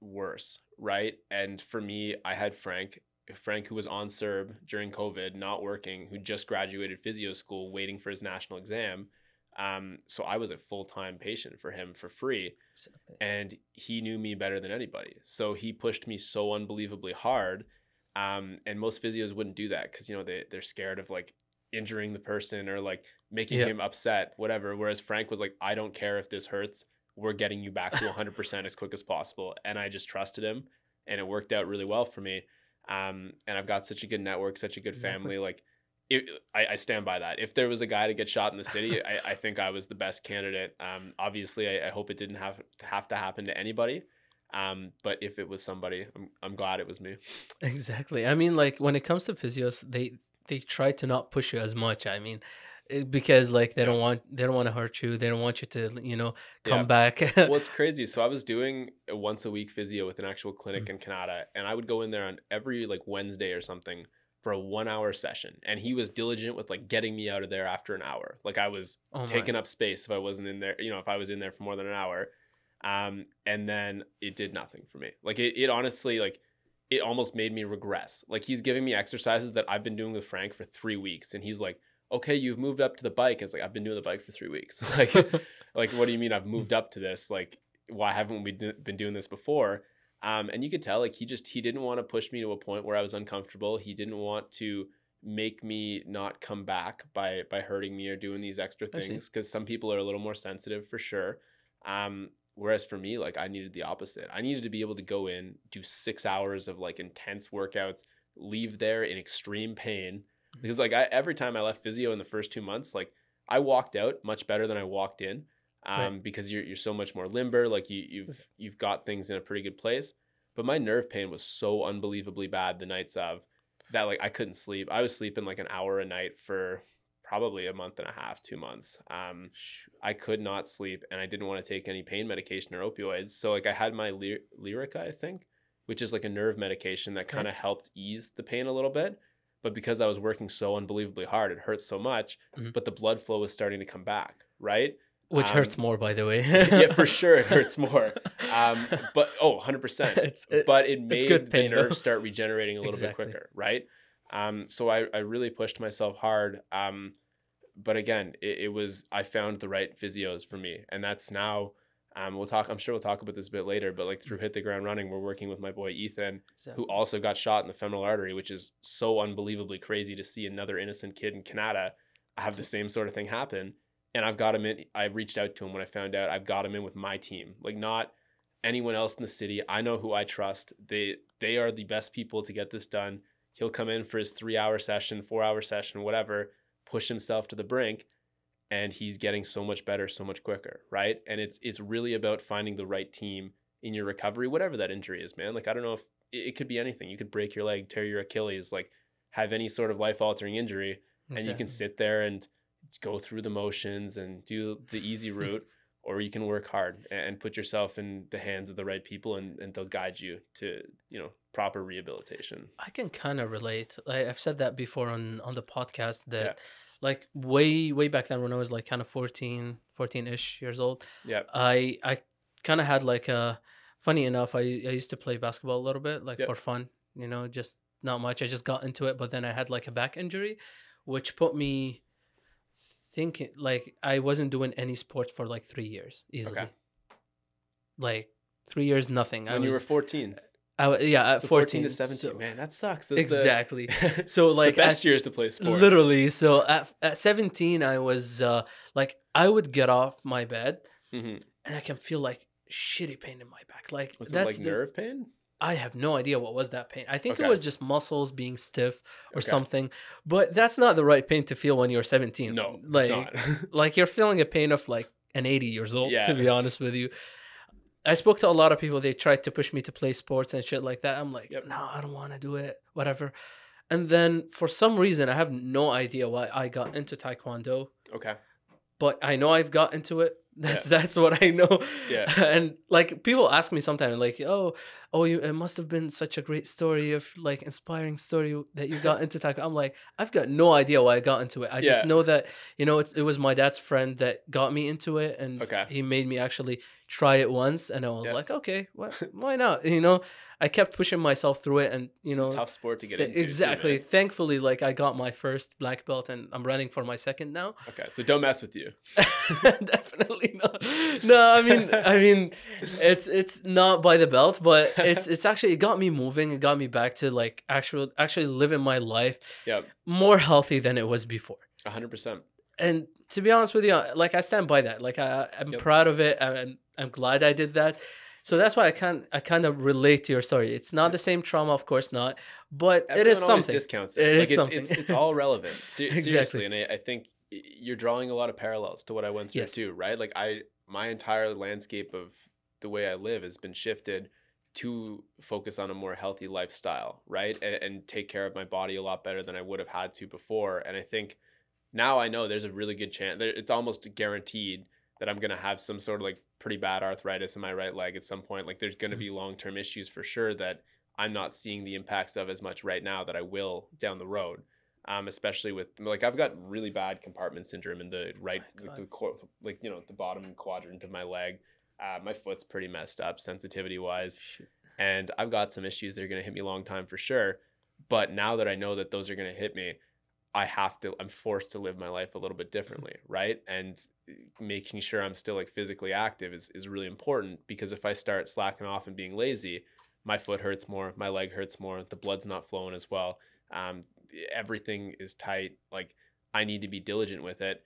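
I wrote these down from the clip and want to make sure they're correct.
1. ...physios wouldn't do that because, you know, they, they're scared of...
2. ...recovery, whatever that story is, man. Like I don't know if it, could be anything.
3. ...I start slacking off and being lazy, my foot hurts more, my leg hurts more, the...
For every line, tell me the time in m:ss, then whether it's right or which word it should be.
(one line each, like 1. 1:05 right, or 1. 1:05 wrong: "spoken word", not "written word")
1. 0:19 right
2. 3:14 wrong: "injury", not "story"
3. 6:28 right.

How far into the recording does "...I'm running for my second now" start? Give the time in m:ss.
5:06.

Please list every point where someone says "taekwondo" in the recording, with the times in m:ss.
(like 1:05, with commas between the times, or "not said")
4:37, 4:49.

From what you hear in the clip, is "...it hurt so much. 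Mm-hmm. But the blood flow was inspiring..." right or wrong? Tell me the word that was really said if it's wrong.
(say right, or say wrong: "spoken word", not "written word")
wrong: "starting", not "inspiring".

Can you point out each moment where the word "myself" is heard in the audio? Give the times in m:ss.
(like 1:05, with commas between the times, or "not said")
2:35, 5:01.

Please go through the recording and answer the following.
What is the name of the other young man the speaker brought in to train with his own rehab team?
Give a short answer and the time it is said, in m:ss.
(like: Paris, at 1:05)
Ethan, at 2:45.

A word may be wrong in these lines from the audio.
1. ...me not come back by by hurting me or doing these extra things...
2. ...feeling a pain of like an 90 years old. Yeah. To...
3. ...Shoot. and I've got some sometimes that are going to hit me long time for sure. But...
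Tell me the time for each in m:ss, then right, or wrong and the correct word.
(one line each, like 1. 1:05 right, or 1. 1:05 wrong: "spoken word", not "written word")
1. 1:35 right
2. 4:24 wrong: "80", not "90"
3. 6:14 wrong: "issues", not "sometimes".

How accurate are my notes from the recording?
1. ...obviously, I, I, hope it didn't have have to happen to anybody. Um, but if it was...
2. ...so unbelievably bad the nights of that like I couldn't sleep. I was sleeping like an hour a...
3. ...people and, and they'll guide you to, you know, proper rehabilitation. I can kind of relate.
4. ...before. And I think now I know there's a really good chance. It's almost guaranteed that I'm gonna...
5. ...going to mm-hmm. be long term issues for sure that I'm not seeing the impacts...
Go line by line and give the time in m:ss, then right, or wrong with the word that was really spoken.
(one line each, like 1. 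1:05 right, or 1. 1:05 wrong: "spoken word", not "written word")
1. 0:41 right
2. 2:01 right
3. 3:29 right
4. 5:50 right
5. 5:58 right.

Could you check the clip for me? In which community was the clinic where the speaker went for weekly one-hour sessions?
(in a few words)
Kanata.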